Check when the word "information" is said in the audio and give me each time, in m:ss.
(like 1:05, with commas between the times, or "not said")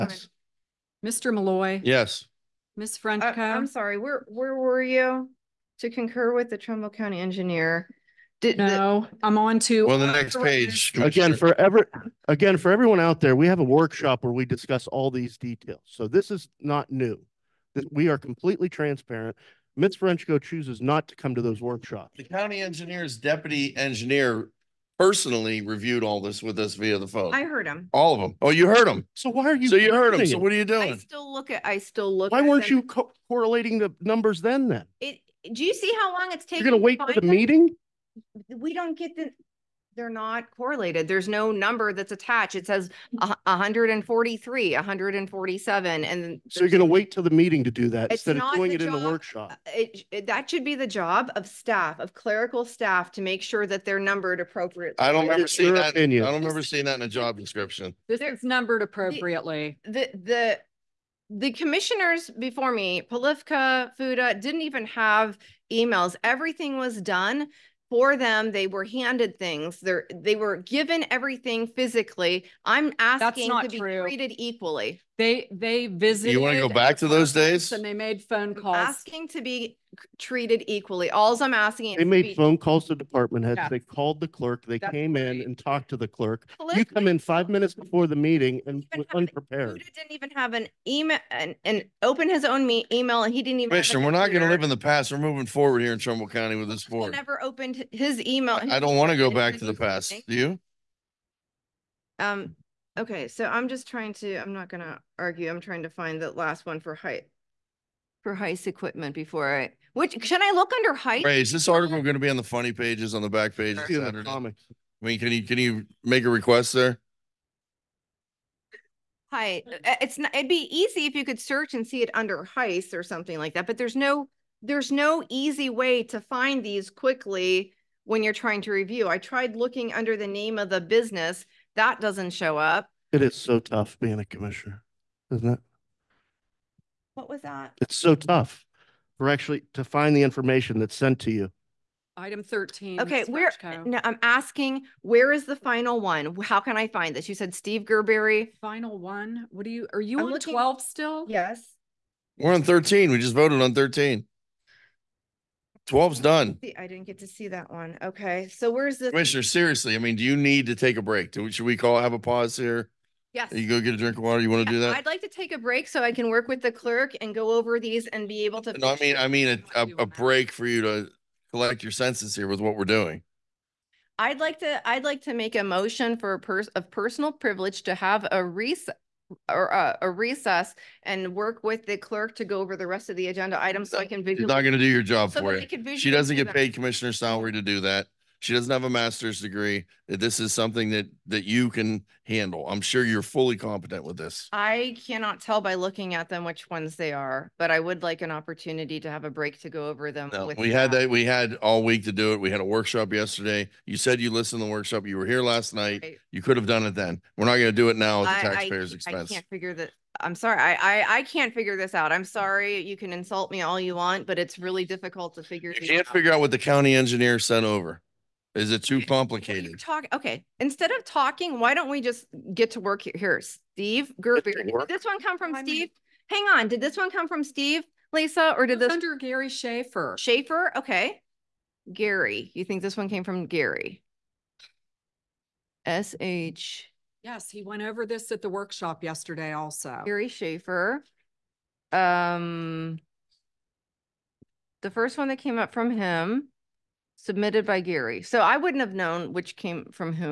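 2:20.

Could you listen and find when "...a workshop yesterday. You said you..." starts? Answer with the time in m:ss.
3:22.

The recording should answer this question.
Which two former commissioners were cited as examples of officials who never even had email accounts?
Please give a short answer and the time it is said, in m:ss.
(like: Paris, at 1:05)
Polifka, Fuda, at 1:03.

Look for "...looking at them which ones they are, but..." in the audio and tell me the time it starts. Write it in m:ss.
3:15.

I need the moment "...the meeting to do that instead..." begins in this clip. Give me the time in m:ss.
0:47.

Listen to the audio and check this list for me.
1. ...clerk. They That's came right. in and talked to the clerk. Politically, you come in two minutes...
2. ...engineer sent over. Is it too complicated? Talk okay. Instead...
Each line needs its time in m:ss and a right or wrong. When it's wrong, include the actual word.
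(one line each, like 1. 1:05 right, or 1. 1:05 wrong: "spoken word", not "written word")
1. 1:24 wrong: "five", not "two"
2. 3:36 right.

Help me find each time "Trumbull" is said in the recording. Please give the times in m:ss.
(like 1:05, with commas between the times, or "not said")
0:06, 1:35.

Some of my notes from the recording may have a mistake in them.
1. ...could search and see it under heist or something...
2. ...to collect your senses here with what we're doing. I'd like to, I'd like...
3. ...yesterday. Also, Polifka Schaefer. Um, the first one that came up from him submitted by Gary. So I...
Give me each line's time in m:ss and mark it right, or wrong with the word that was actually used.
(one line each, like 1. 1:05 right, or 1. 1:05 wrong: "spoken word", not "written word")
1. 2:01 right
2. 2:50 right
3. 3:59 wrong: "Gary", not "Polifka".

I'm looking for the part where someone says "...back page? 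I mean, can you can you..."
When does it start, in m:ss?
1:53.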